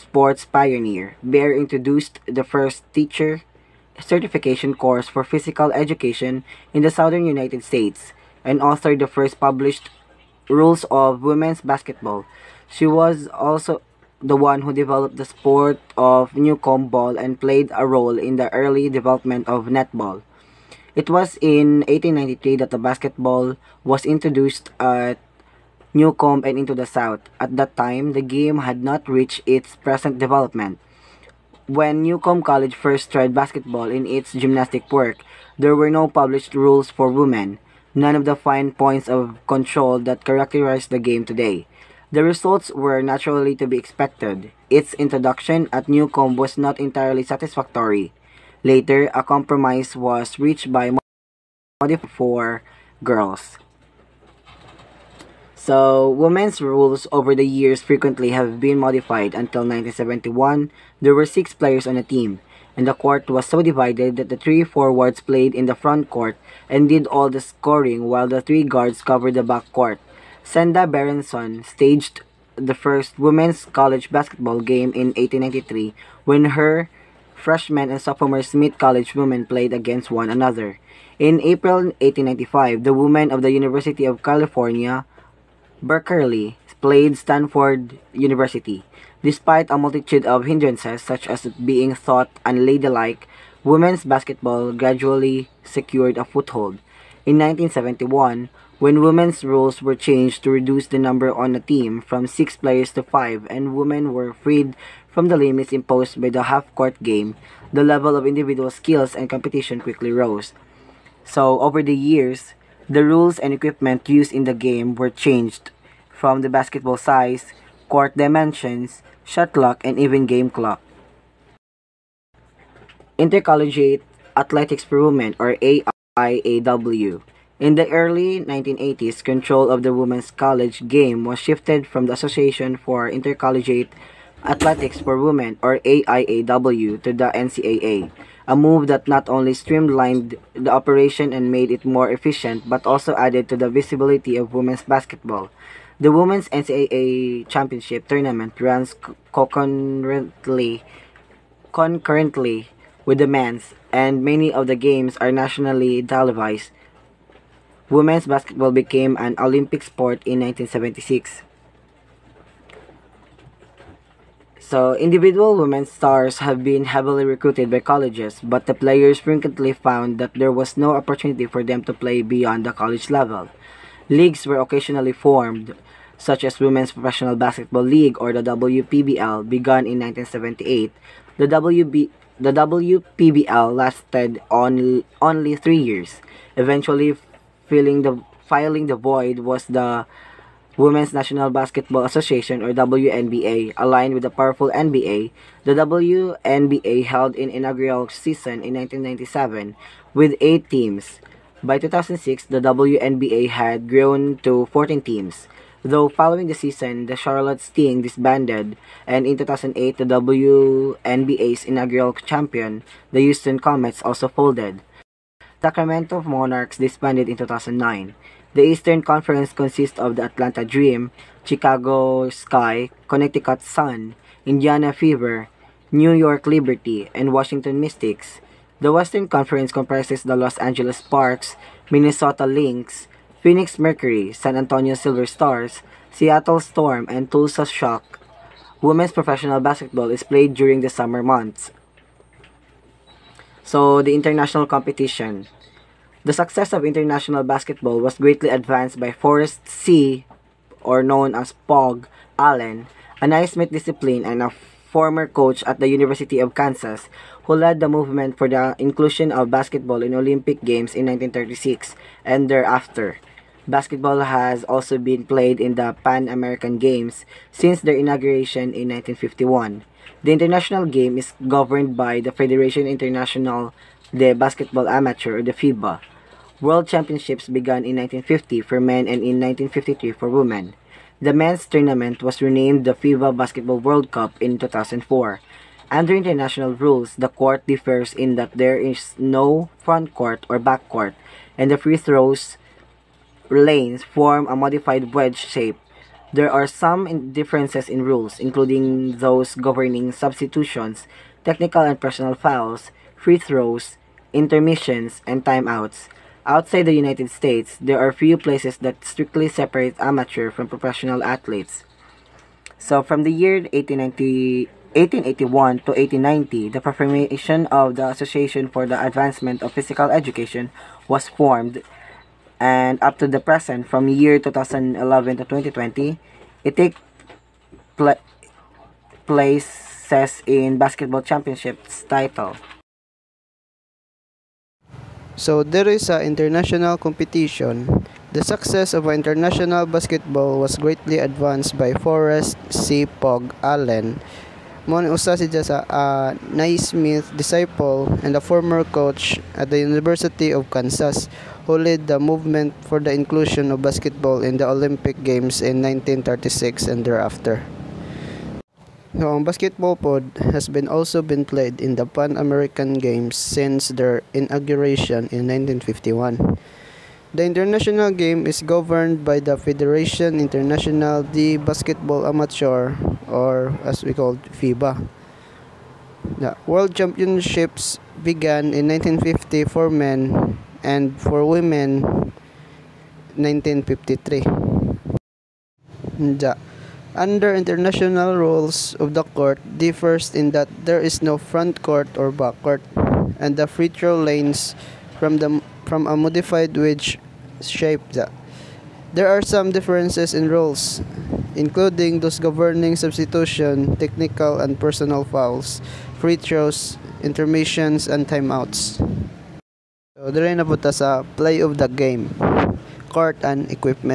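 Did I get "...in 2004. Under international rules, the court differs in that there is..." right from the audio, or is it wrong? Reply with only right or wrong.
right.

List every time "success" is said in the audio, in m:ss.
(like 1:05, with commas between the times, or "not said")
4:06, 5:38.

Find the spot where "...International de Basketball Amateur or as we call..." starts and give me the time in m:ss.
6:10.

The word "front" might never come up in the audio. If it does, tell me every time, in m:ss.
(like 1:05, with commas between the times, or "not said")
1:05, 4:49, 6:31.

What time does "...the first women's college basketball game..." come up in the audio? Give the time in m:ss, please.
1:12.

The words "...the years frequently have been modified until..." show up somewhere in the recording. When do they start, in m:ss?
0:57.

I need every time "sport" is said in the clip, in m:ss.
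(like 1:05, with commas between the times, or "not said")
0:15, 2:39.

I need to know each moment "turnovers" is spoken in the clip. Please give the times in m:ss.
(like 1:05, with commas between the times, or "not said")
not said.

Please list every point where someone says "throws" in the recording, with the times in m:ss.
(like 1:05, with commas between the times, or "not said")
4:51, 5:03, 6:33, 6:46.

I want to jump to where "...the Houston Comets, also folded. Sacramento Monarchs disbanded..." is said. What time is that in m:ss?
3:33.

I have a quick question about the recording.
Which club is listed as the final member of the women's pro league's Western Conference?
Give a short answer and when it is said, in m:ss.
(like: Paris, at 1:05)
Tulsa Shock, at 3:57.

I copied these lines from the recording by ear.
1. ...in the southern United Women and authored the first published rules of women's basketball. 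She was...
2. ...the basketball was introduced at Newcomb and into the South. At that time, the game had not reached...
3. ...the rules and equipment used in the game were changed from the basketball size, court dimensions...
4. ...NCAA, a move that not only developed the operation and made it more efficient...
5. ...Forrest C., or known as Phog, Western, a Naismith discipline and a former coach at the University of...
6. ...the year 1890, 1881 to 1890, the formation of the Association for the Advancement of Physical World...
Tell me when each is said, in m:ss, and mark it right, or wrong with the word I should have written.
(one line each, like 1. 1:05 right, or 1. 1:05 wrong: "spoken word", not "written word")
1. 0:06 wrong: "States", not "Women"
2. 0:22 right
3. 1:52 right
4. 2:17 wrong: "streamlined", not "developed"
5. 4:09 wrong: "Allen", not "Western"
6. 5:13 wrong: "Education", not "World".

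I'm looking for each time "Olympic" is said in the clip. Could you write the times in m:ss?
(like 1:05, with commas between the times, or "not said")
2:39, 4:20, 5:54.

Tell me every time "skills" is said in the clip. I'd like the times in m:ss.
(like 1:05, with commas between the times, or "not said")
1:48.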